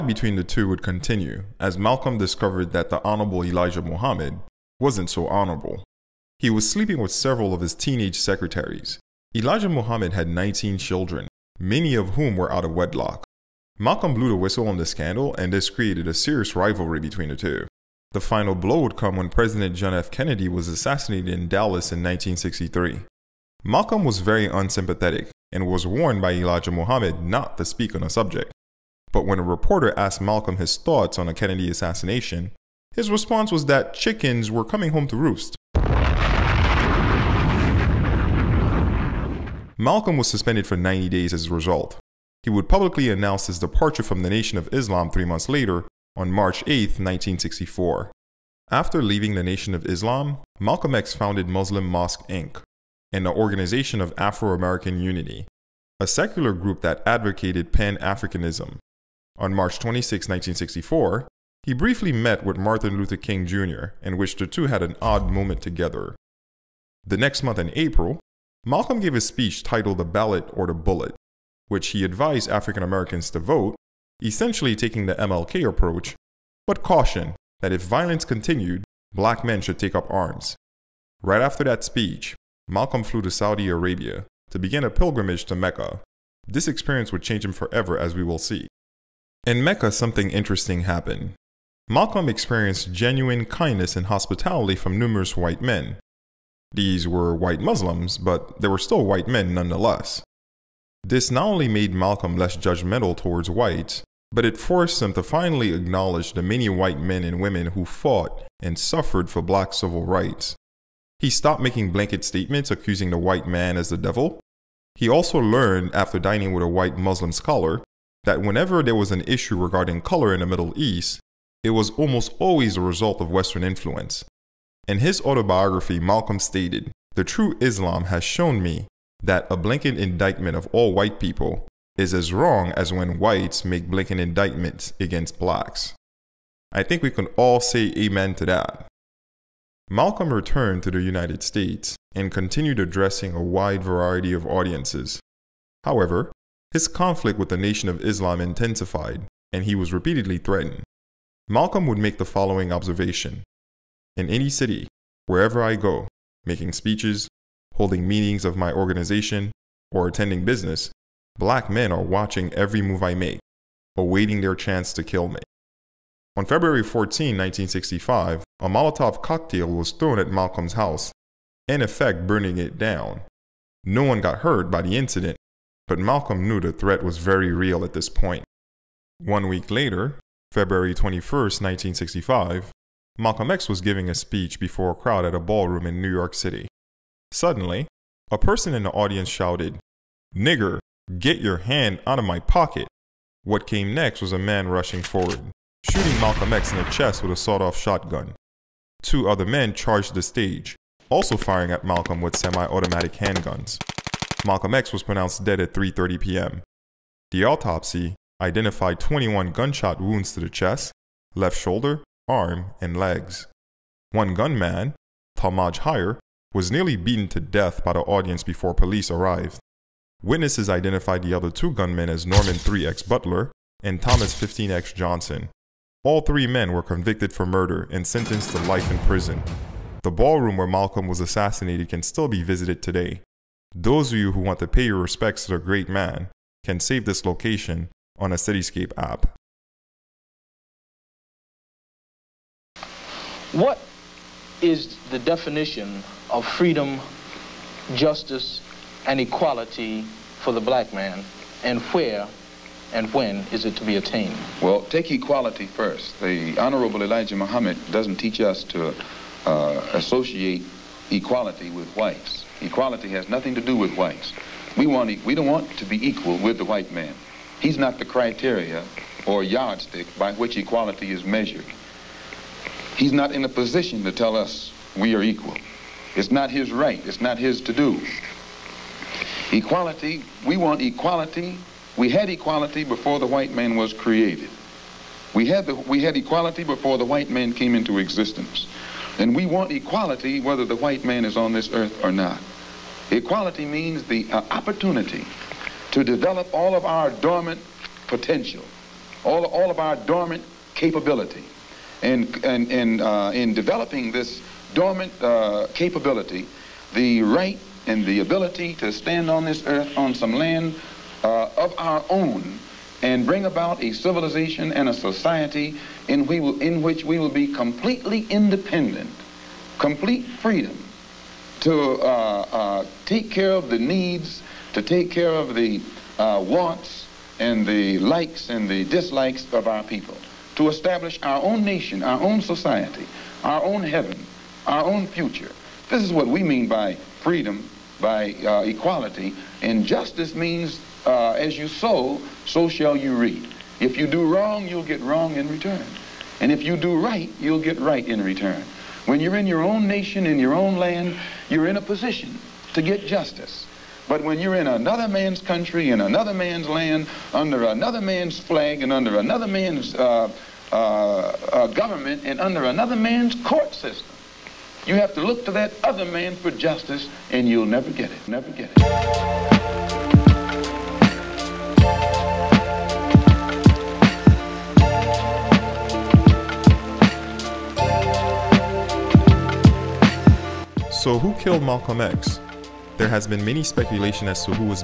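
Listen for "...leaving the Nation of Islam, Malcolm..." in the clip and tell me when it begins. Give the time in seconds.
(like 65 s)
49 s.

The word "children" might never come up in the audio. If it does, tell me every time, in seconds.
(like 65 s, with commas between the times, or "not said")
10 s.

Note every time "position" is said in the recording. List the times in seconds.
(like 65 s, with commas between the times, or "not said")
273 s, 351 s.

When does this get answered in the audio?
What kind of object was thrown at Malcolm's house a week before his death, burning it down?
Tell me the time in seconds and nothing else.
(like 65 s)
168 s.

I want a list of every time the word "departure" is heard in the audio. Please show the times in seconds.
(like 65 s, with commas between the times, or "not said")
43 s.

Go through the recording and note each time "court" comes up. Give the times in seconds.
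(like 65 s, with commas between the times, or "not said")
363 s.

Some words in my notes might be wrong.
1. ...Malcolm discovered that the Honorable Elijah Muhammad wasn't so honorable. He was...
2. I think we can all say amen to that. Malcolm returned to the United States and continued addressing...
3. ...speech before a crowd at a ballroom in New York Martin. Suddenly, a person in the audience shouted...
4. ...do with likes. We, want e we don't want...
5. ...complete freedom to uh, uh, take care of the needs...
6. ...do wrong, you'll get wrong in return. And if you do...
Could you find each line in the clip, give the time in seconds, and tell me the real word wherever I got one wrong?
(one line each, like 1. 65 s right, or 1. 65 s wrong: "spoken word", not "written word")
1. 1 s right
2. 136 s right
3. 184 s wrong: "City", not "Martin"
4. 263 s wrong: "whites", not "likes"
5. 319 s right
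6. 344 s right.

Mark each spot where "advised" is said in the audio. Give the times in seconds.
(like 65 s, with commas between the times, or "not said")
72 s.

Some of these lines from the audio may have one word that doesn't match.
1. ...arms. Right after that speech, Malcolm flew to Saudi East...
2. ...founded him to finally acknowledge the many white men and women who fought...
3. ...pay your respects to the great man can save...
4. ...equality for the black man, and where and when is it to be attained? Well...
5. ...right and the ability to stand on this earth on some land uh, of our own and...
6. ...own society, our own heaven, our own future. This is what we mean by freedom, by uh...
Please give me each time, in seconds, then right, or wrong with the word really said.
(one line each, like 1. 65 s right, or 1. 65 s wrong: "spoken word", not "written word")
1. 80 s wrong: "Arabia", not "East"
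2. 104 s wrong: "forced", not "founded"
3. 234 s right
4. 249 s right
5. 307 s right
6. 332 s right.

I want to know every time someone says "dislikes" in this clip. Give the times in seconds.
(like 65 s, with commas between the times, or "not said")
328 s.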